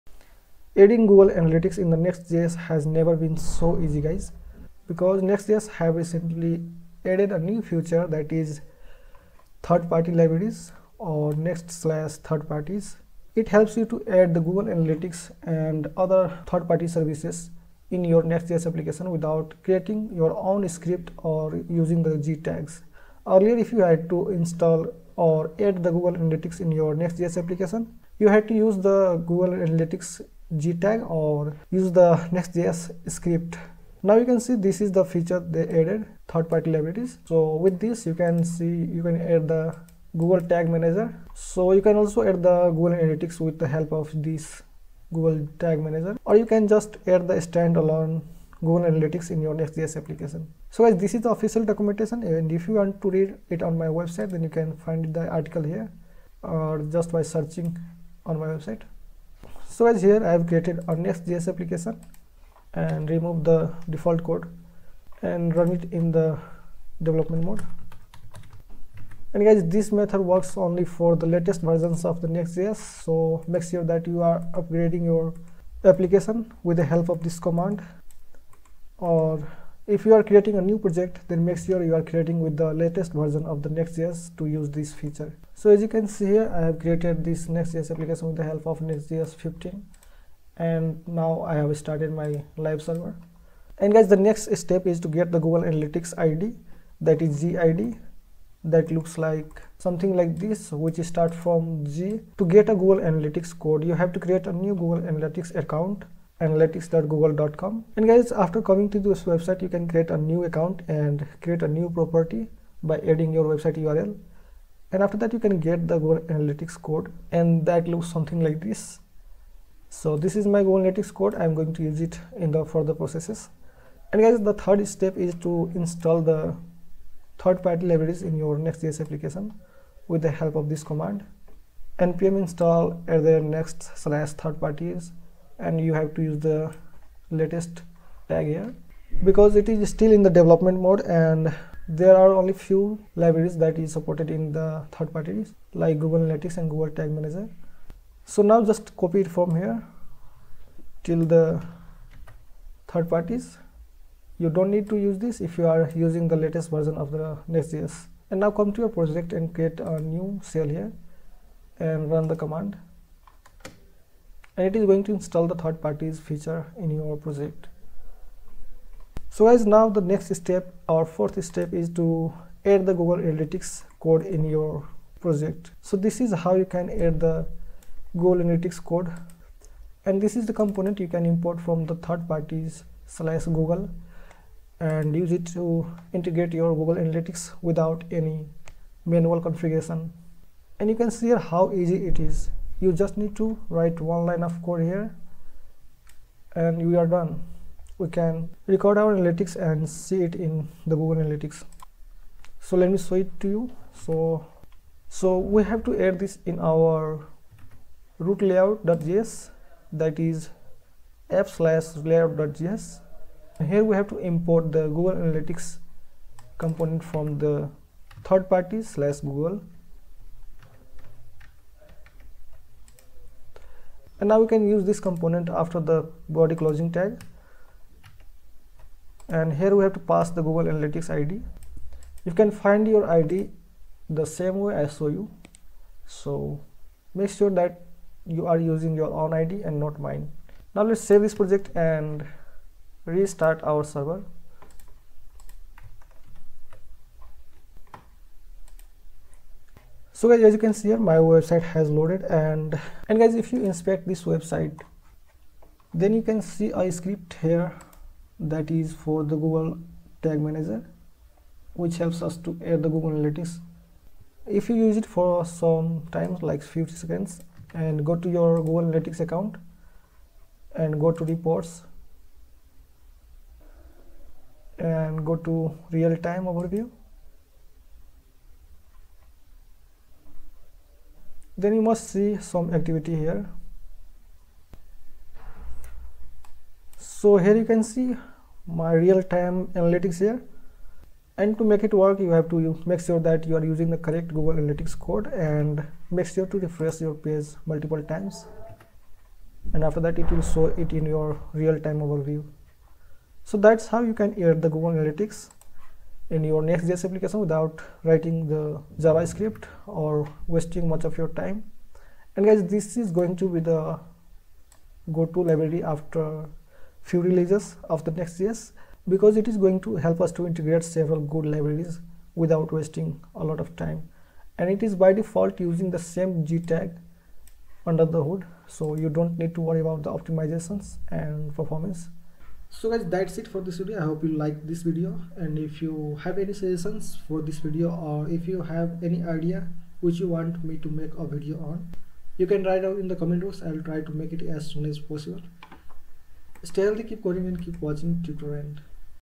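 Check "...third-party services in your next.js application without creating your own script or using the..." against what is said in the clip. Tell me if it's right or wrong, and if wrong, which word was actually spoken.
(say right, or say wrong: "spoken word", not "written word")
right.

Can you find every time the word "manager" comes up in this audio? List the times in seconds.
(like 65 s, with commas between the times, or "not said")
40 s, 45 s, 147 s, 260 s.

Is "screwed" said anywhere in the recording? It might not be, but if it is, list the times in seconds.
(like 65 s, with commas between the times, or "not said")
not said.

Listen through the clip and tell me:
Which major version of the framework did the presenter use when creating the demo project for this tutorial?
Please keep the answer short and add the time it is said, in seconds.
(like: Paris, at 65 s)
Next.js 15, at 88 s.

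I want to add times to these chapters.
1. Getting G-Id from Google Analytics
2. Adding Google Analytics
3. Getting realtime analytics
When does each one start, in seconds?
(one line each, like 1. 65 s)
1. 100 s
2. 168 s
3. 250 s.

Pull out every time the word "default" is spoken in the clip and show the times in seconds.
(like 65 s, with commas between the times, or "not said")
63 s, 325 s.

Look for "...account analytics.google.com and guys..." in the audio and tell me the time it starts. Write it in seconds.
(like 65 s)
105 s.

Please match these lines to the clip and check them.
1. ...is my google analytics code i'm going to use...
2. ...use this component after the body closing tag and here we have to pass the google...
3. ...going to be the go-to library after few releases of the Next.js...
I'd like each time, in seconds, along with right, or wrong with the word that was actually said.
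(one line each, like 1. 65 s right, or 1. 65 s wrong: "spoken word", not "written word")
1. 120 s right
2. 224 s right
3. 313 s right.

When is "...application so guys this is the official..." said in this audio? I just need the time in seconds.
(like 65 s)
49 s.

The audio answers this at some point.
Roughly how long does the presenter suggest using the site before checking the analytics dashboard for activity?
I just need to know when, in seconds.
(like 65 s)
266 s.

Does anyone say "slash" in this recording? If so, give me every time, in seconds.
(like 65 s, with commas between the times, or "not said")
11 s, 134 s, 183 s, 211 s, 218 s.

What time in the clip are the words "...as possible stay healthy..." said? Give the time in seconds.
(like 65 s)
344 s.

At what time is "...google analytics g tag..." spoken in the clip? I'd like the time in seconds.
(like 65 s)
29 s.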